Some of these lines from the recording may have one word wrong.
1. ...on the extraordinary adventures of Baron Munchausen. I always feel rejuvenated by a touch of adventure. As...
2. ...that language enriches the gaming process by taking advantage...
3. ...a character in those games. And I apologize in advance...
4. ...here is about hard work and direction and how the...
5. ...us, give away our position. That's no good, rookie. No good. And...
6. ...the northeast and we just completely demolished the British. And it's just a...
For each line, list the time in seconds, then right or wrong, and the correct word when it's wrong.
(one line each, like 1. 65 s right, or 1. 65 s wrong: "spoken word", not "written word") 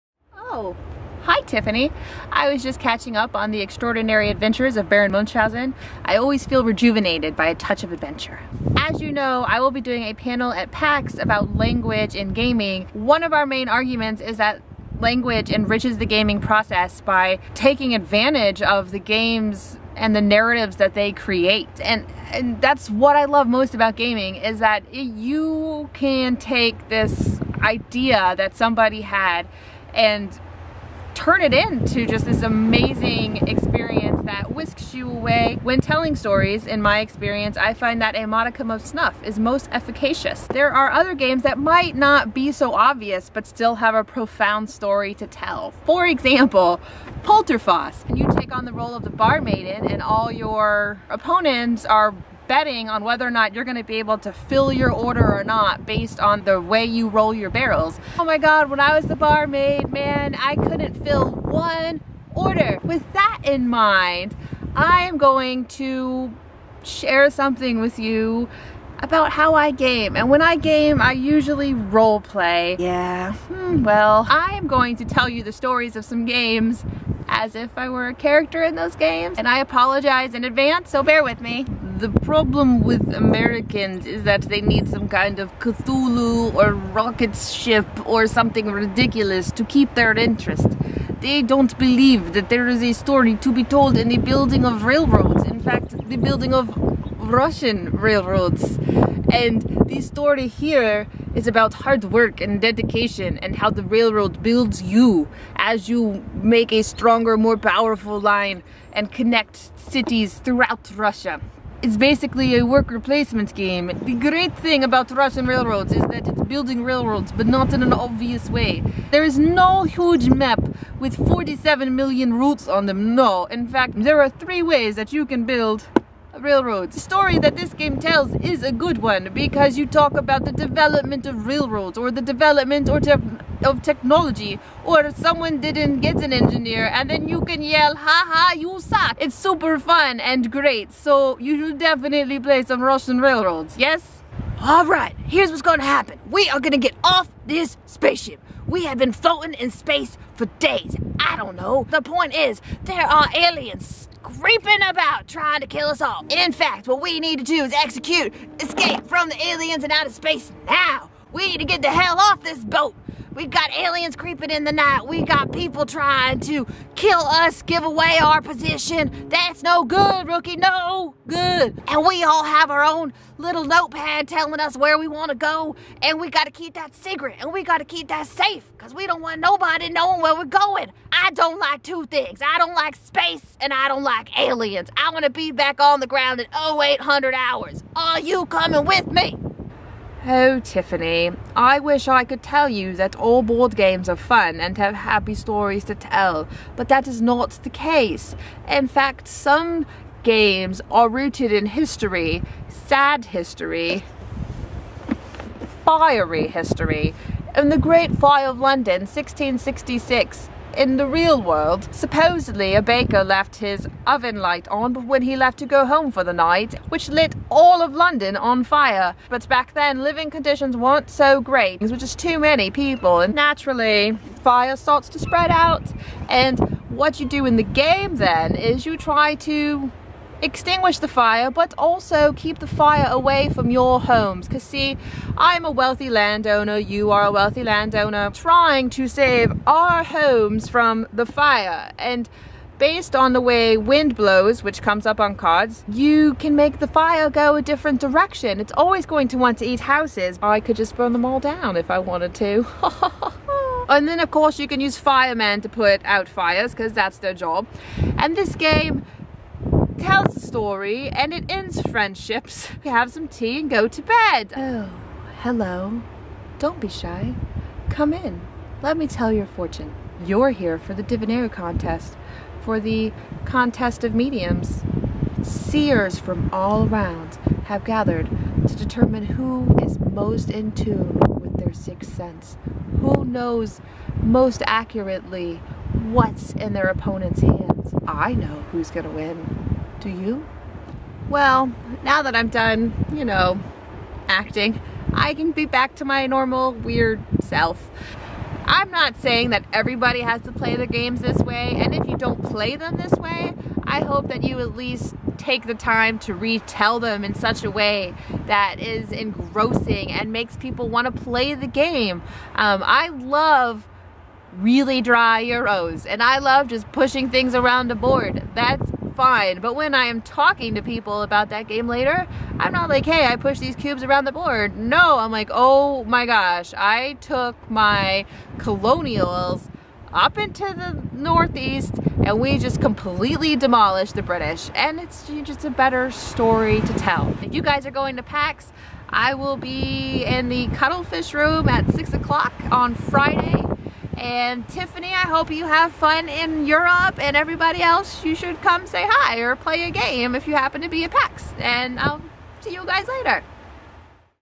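1. 3 s right
2. 14 s right
3. 78 s right
4. 100 s wrong: "dedication", not "direction"
5. 167 s right
6. 330 s right.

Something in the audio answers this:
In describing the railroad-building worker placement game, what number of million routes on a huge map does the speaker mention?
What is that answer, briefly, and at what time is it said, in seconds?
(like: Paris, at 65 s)
47, at 121 s.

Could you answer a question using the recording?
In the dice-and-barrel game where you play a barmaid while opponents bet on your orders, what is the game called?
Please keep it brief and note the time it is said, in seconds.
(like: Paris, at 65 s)
Polterfass, at 47 s.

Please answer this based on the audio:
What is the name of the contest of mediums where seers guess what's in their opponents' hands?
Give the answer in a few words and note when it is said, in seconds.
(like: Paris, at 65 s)
Divinare, at 271 s.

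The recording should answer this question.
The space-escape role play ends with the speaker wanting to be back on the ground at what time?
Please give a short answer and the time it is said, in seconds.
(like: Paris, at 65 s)
0800 hours, at 186 s.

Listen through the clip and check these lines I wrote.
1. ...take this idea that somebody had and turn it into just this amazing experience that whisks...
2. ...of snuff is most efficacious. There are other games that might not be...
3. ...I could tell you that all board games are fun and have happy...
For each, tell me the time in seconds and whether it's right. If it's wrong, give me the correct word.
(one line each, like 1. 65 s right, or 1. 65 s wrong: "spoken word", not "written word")
1. 26 s right
2. 38 s right
3. 192 s right.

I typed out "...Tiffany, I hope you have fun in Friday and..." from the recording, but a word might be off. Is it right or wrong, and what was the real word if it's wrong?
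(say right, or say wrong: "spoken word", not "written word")
wrong: "Europe", not "Friday".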